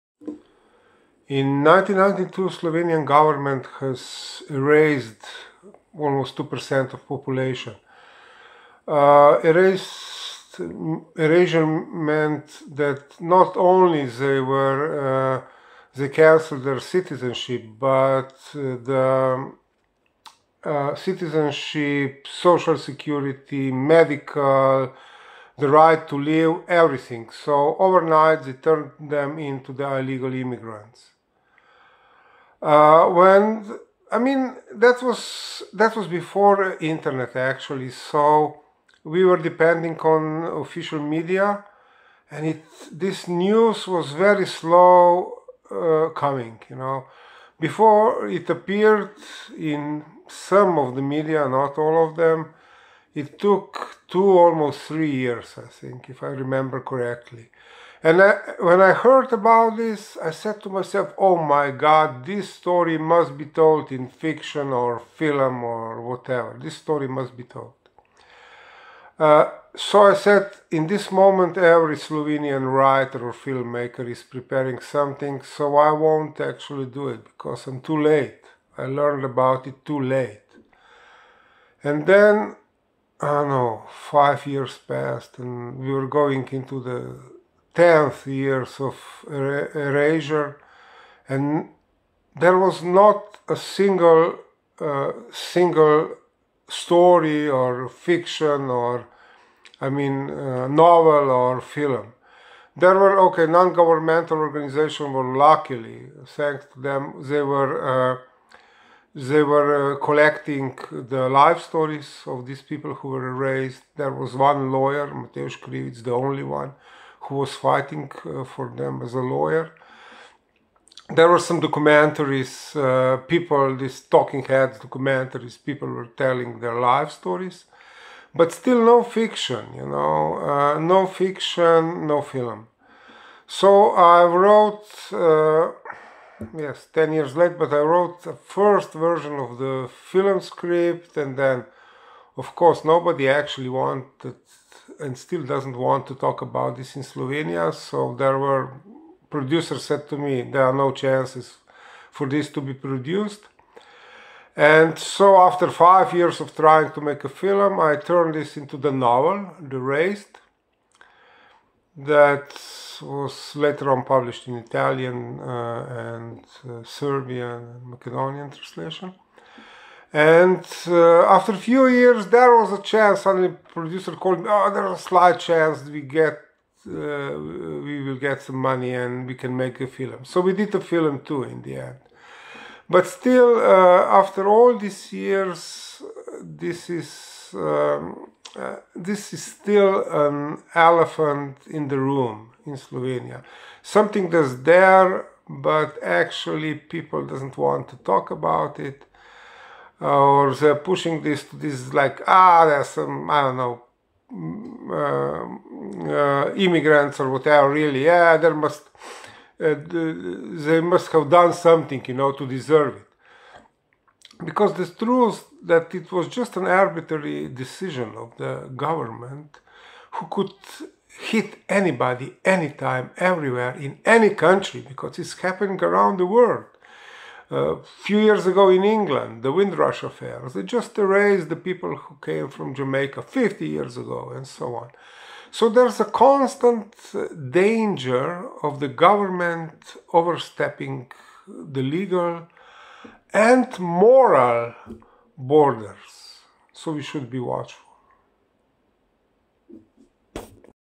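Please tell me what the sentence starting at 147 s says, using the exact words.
So there were producers said to me, There are no chances for this to be produced.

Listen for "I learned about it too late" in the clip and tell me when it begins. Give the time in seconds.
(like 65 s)
78 s.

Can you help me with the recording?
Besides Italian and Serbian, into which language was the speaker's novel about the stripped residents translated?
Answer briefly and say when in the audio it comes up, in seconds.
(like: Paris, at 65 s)
Macedonian, at 167 s.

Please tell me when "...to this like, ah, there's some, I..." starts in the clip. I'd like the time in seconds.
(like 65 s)
201 s.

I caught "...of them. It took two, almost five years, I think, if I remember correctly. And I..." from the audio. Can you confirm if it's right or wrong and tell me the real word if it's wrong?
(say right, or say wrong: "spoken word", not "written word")
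wrong: "three", not "five".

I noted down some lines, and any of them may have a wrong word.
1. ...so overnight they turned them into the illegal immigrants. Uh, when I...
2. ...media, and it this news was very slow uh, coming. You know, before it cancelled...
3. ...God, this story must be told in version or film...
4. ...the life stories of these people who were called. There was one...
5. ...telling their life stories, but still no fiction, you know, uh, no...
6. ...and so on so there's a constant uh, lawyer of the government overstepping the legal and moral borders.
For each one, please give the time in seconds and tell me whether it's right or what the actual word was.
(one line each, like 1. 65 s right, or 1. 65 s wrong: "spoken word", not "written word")
1. 27 s right
2. 40 s wrong: "appeared", not "cancelled"
3. 61 s wrong: "fiction", not "version"
4. 110 s wrong: "erased", not "called"
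5. 126 s right
6. 234 s wrong: "danger", not "lawyer".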